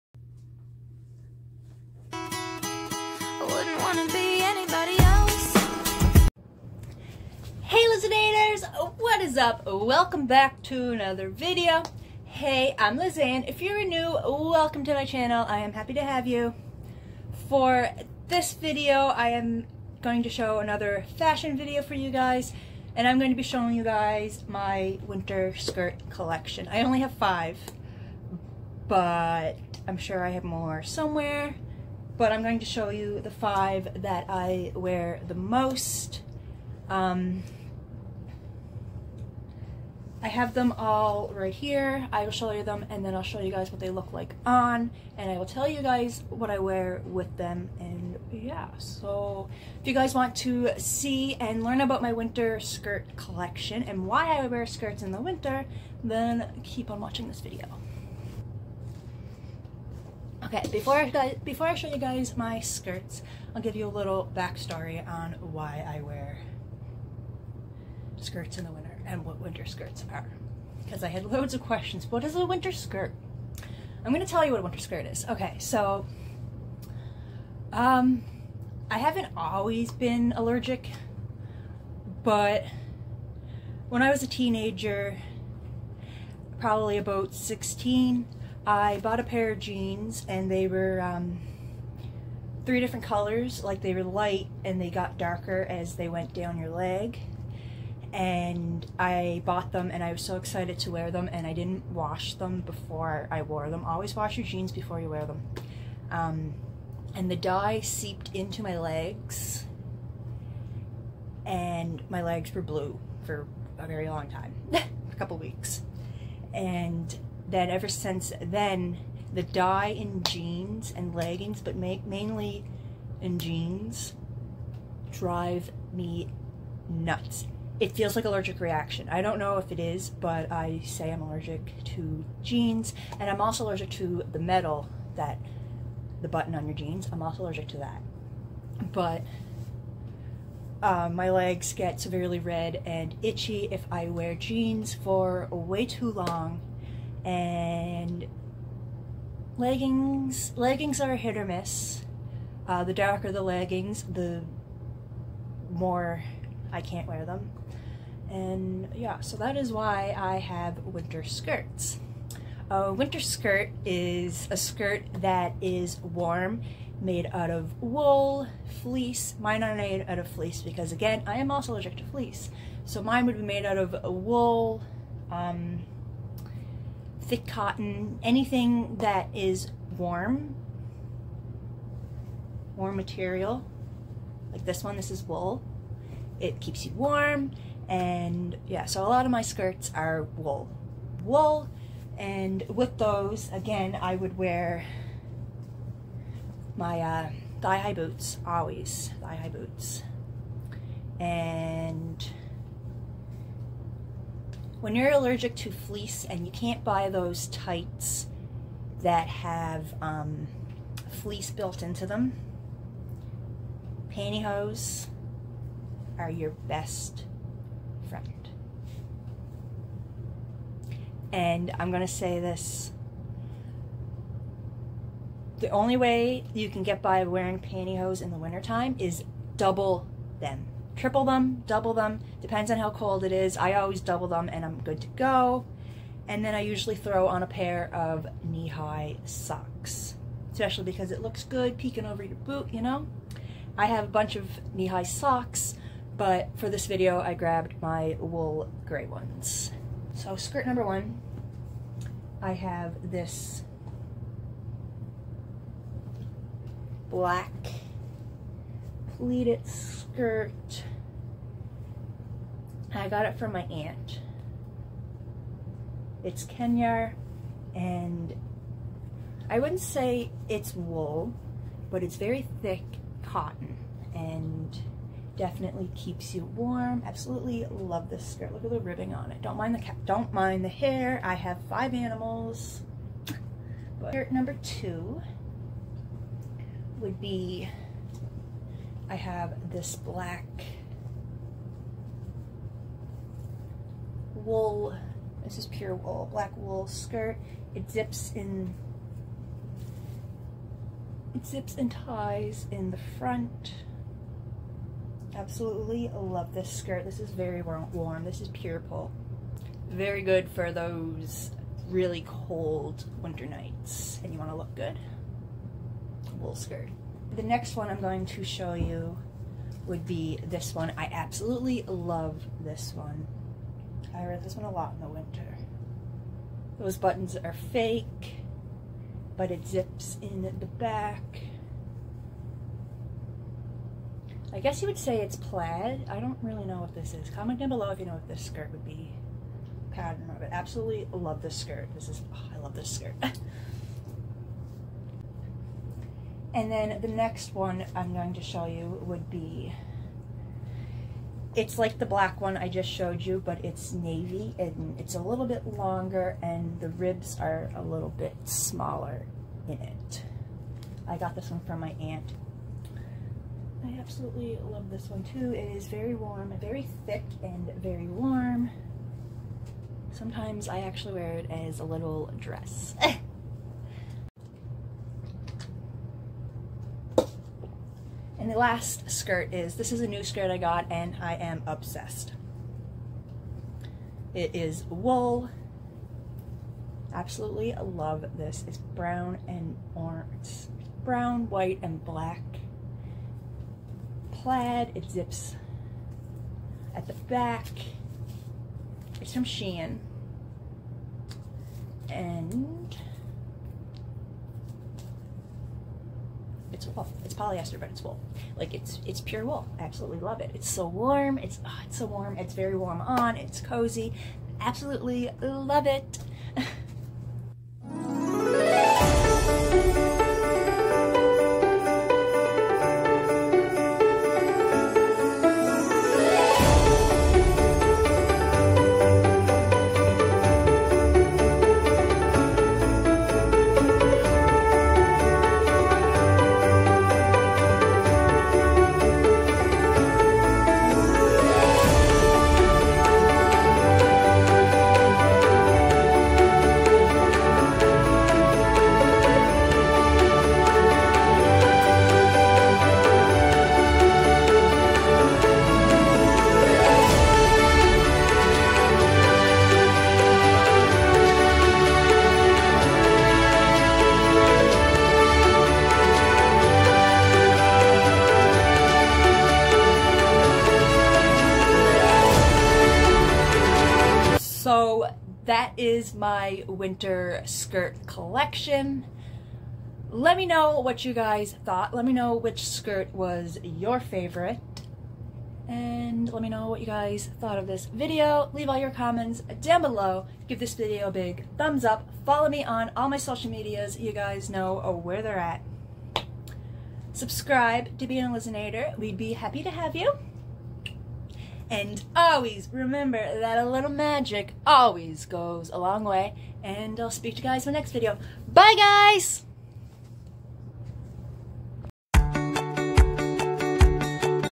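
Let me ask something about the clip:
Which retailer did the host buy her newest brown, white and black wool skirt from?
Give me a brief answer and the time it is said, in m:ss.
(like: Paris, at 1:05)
Shein, at 6:39.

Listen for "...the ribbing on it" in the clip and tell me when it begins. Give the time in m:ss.
4:38.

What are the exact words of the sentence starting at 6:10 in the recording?
Sometimes I actually wear it as a little dress.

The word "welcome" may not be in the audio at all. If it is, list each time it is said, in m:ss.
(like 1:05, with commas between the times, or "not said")
0:09, 0:14.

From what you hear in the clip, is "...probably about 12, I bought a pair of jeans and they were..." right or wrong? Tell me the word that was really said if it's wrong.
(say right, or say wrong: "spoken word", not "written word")
wrong: "16", not "12".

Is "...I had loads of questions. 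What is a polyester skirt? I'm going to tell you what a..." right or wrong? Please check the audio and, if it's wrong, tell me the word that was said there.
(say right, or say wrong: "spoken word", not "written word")
wrong: "winter", not "polyester".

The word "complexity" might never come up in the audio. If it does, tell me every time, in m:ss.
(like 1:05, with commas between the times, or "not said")
not said.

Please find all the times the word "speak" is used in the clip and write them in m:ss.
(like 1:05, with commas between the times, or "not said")
8:27.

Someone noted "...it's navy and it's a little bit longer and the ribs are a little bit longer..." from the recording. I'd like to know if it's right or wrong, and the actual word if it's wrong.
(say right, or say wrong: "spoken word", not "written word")
wrong: "smaller", not "longer".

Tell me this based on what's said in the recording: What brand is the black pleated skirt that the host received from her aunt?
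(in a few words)
Kenar.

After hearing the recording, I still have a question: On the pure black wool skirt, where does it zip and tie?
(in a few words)
In the front.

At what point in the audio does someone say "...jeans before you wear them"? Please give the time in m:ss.
1:44.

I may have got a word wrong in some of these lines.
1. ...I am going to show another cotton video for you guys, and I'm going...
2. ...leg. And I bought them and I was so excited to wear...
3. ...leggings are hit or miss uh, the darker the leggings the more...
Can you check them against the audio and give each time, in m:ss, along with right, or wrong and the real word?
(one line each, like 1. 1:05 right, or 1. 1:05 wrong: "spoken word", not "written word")
1. 0:19 wrong: "fashion", not "cotton"
2. 1:36 right
3. 2:30 right.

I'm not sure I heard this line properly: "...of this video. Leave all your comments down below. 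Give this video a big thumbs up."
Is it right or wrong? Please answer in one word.
right.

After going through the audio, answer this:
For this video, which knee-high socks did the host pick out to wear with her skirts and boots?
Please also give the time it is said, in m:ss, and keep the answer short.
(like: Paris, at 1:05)
Wool gray ones, at 4:08.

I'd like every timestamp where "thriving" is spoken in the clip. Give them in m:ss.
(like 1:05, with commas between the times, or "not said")
not said.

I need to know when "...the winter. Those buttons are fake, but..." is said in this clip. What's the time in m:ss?
5:25.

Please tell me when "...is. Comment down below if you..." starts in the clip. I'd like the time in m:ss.
5:37.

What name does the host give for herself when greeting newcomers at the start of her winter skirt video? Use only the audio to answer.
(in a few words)
LizzAnn.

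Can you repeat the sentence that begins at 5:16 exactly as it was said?
Wool skirt the next one I'm going to show you would be this one.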